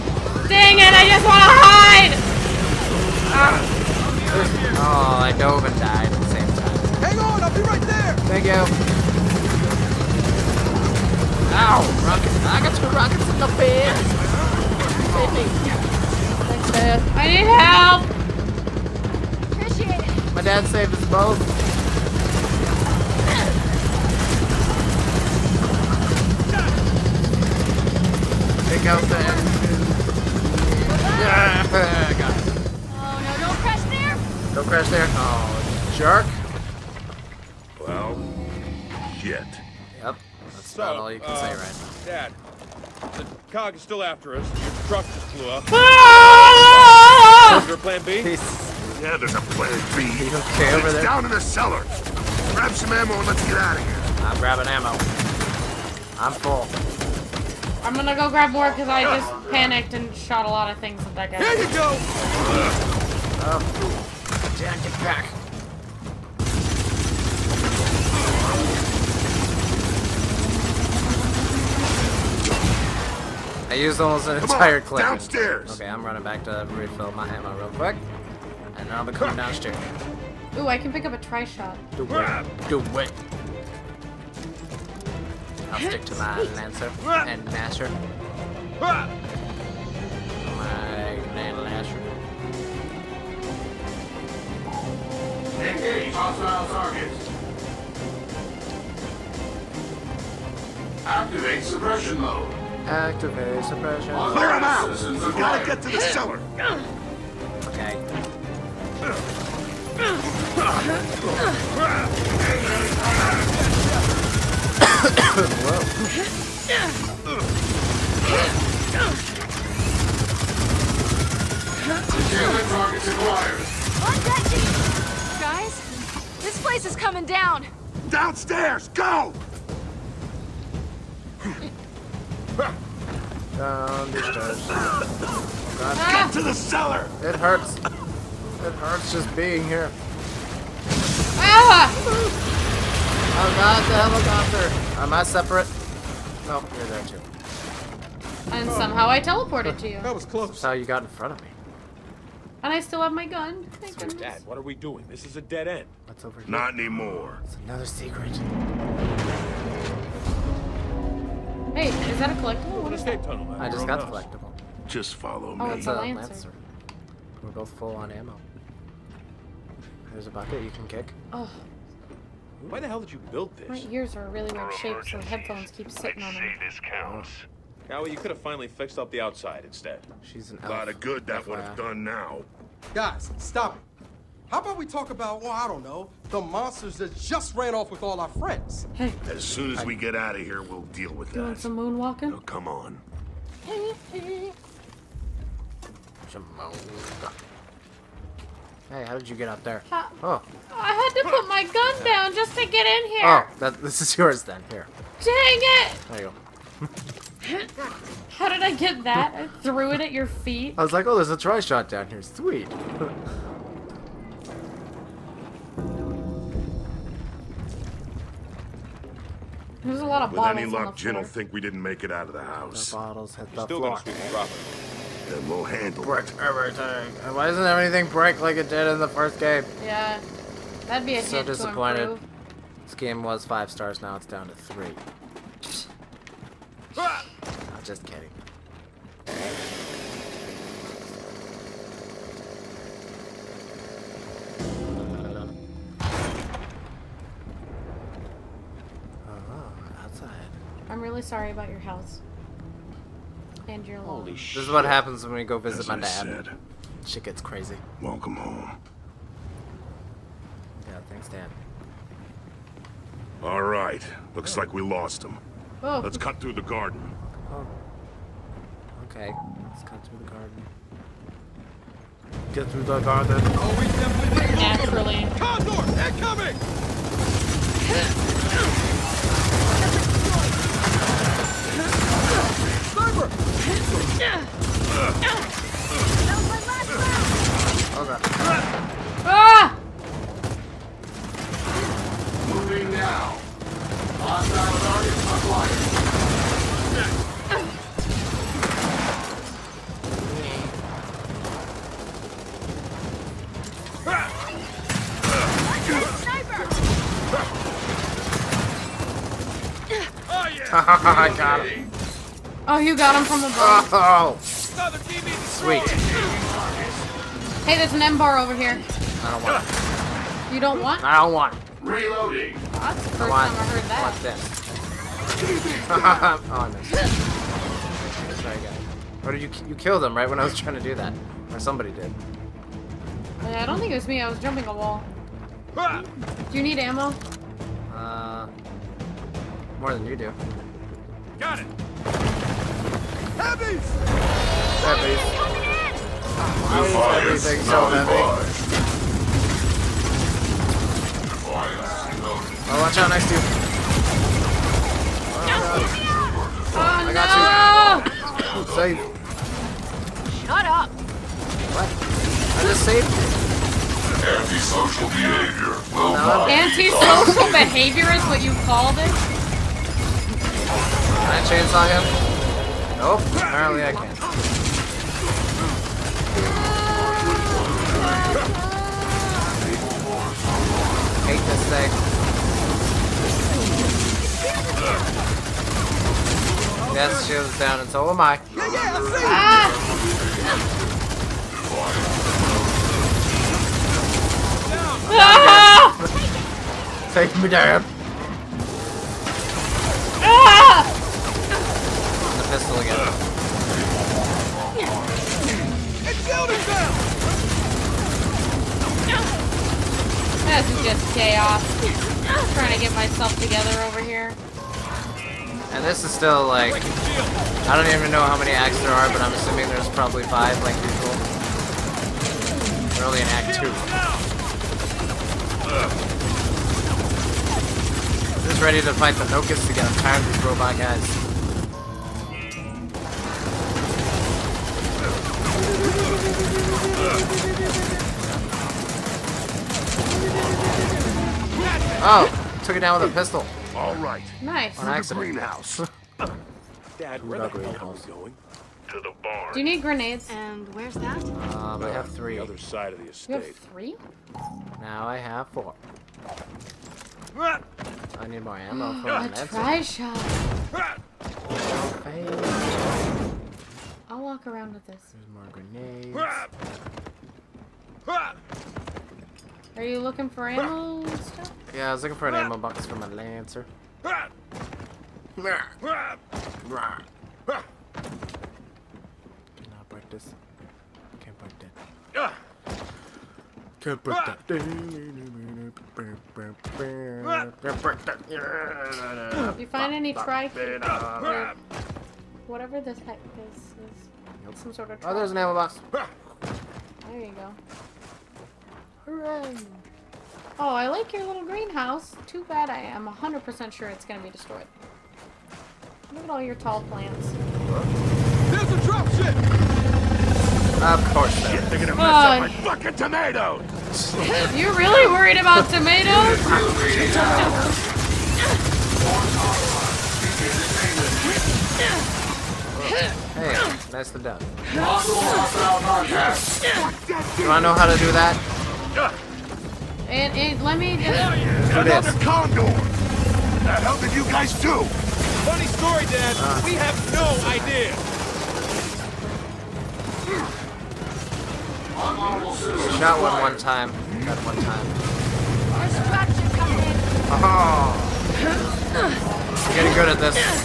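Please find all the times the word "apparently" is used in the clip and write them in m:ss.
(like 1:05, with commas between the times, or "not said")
6:13.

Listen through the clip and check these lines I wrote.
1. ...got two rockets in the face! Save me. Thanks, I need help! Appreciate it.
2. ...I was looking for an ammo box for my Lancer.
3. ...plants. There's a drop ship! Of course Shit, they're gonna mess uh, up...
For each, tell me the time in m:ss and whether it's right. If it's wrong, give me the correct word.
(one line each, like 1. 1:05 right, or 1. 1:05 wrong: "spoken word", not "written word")
1. 0:12 right
2. 7:51 right
3. 8:26 right.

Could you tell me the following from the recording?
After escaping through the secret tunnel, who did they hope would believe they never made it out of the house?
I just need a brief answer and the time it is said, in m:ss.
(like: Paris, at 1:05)
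Jinn, at 3:40.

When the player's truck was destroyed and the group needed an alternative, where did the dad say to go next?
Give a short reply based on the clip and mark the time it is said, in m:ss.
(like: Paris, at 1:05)
Down in the cellar, at 0:51.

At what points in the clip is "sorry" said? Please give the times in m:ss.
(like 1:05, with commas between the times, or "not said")
4:11, 5:28.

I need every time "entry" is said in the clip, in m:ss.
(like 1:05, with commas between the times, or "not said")
not said.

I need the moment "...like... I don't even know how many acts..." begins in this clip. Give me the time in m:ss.
6:56.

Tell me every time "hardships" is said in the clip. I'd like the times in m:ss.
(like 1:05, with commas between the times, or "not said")
not said.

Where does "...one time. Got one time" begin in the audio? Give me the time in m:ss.
9:03.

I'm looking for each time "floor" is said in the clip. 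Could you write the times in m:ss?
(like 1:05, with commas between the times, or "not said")
3:43.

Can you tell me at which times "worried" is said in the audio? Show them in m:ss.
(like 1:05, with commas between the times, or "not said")
8:35.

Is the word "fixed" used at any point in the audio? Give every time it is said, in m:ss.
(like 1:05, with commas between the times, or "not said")
2:58.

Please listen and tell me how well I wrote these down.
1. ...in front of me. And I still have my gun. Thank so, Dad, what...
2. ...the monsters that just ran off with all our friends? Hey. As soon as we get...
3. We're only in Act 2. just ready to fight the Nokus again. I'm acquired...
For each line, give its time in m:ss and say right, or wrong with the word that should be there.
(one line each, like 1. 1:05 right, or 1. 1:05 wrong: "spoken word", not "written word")
1. 2:31 right
2. 3:06 right
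3. 7:02 wrong: "tired", not "acquired".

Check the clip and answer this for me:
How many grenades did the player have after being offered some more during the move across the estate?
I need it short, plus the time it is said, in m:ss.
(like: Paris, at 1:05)
4, at 7:35.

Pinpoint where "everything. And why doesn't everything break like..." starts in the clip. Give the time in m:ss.
3:46.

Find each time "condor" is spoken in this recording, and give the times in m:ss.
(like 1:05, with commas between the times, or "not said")
4:35, 8:52.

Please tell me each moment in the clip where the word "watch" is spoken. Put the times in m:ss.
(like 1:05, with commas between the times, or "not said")
5:24, 5:52.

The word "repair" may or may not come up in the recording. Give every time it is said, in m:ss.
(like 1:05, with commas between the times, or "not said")
not said.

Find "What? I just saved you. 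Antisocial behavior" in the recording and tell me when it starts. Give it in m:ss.
6:01.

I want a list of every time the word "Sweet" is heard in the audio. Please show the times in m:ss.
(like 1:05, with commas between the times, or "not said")
3:32, 5:14.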